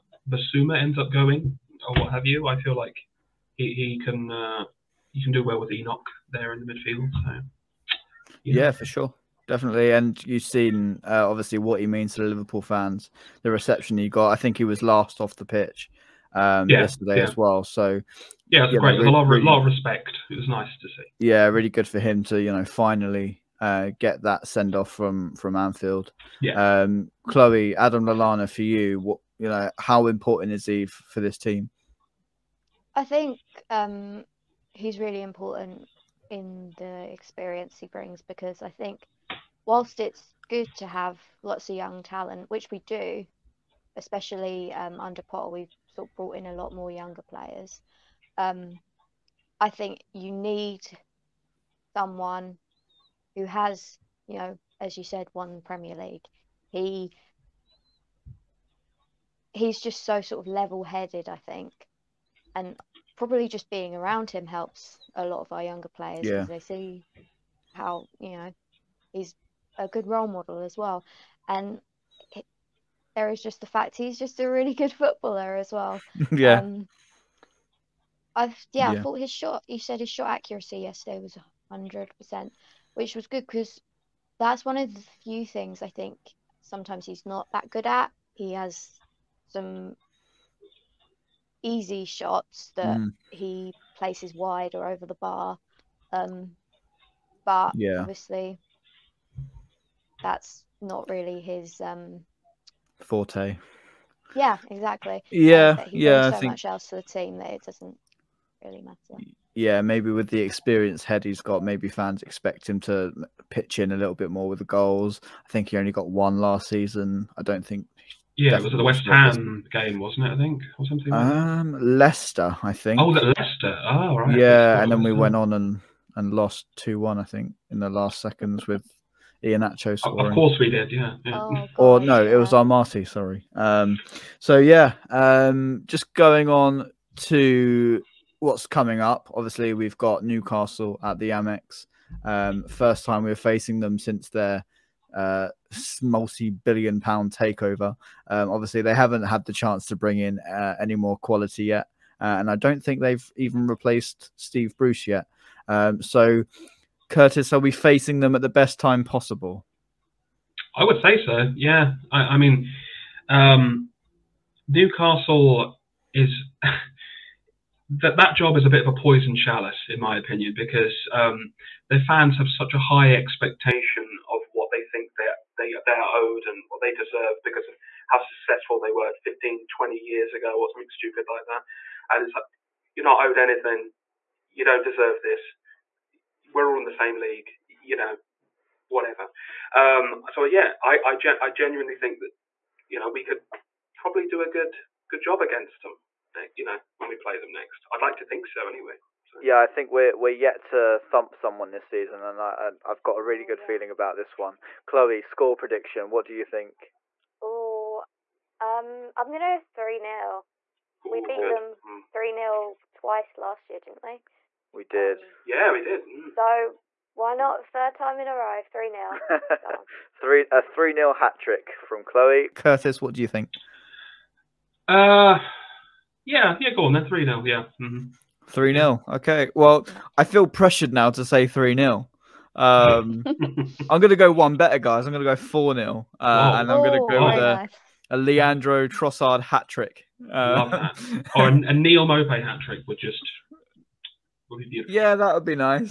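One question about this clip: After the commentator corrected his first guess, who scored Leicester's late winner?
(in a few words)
Amartey.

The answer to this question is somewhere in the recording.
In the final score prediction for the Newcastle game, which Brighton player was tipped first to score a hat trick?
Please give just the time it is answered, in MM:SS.
03:58.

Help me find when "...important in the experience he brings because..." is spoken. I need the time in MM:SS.
00:35.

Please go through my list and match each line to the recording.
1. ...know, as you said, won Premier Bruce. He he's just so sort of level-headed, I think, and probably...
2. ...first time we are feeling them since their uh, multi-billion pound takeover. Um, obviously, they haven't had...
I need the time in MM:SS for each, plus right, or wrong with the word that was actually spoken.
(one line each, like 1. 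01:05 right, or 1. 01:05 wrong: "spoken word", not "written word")
1. 00:54 wrong: "League", not "Bruce"
2. 02:22 wrong: "facing", not "feeling".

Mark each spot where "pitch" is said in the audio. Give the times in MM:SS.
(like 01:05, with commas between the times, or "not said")
00:15, 01:53.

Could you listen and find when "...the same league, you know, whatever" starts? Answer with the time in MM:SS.
03:06.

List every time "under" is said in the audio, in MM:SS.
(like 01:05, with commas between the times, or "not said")
00:45.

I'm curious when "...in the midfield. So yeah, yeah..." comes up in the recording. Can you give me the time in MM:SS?
00:06.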